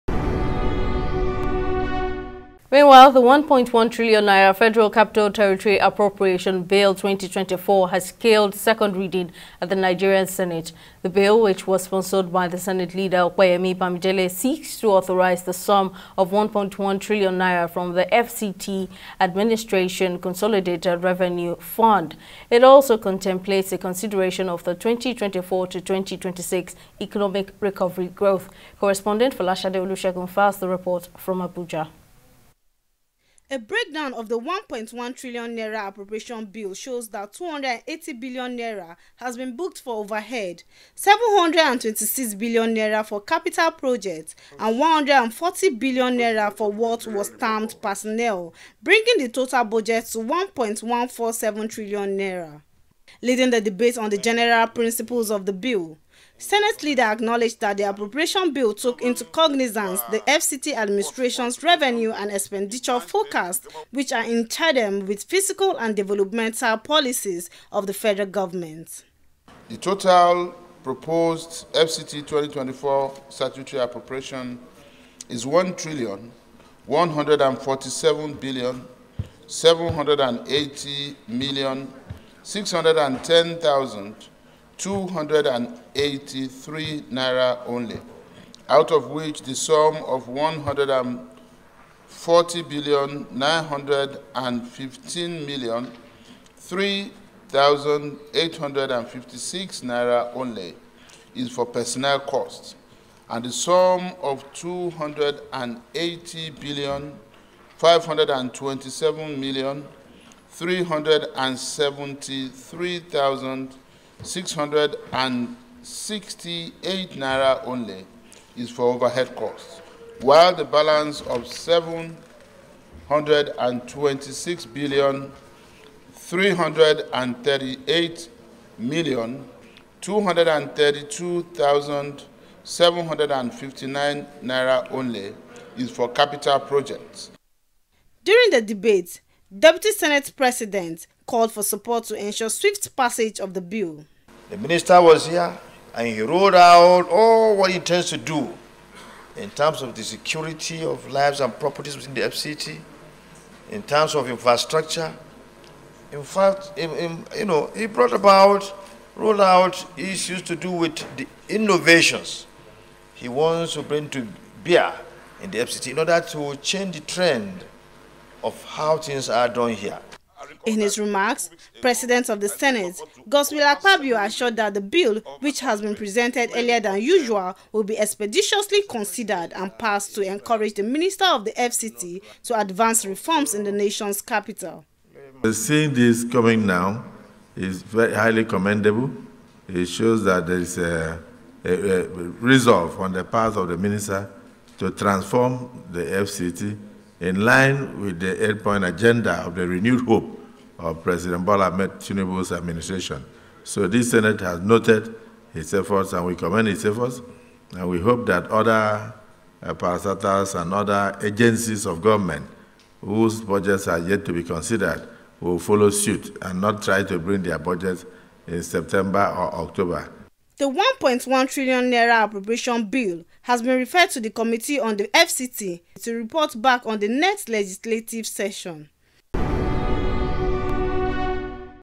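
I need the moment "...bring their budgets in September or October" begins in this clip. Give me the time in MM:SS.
03:37.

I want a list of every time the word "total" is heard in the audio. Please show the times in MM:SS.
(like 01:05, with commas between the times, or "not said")
00:49, 01:09.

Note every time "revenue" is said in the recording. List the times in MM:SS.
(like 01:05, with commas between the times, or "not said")
00:21, 01:01.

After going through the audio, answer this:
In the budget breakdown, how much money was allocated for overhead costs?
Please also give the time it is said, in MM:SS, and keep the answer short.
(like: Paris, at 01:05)
280 billion naira, at 00:37.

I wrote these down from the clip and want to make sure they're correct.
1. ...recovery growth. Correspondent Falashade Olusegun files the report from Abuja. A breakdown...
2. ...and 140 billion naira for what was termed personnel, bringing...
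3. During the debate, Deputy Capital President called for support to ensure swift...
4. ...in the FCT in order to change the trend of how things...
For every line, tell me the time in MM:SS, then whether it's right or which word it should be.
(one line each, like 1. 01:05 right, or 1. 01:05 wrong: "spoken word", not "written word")
1. 00:27 right
2. 00:44 right
3. 02:18 wrong: "Senate", not "Capital"
4. 02:45 right.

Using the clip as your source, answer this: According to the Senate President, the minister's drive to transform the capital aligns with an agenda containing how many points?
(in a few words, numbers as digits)
8.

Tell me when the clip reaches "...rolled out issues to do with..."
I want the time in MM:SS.
02:39.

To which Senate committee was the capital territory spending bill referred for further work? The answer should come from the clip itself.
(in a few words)
Committee on the FCT.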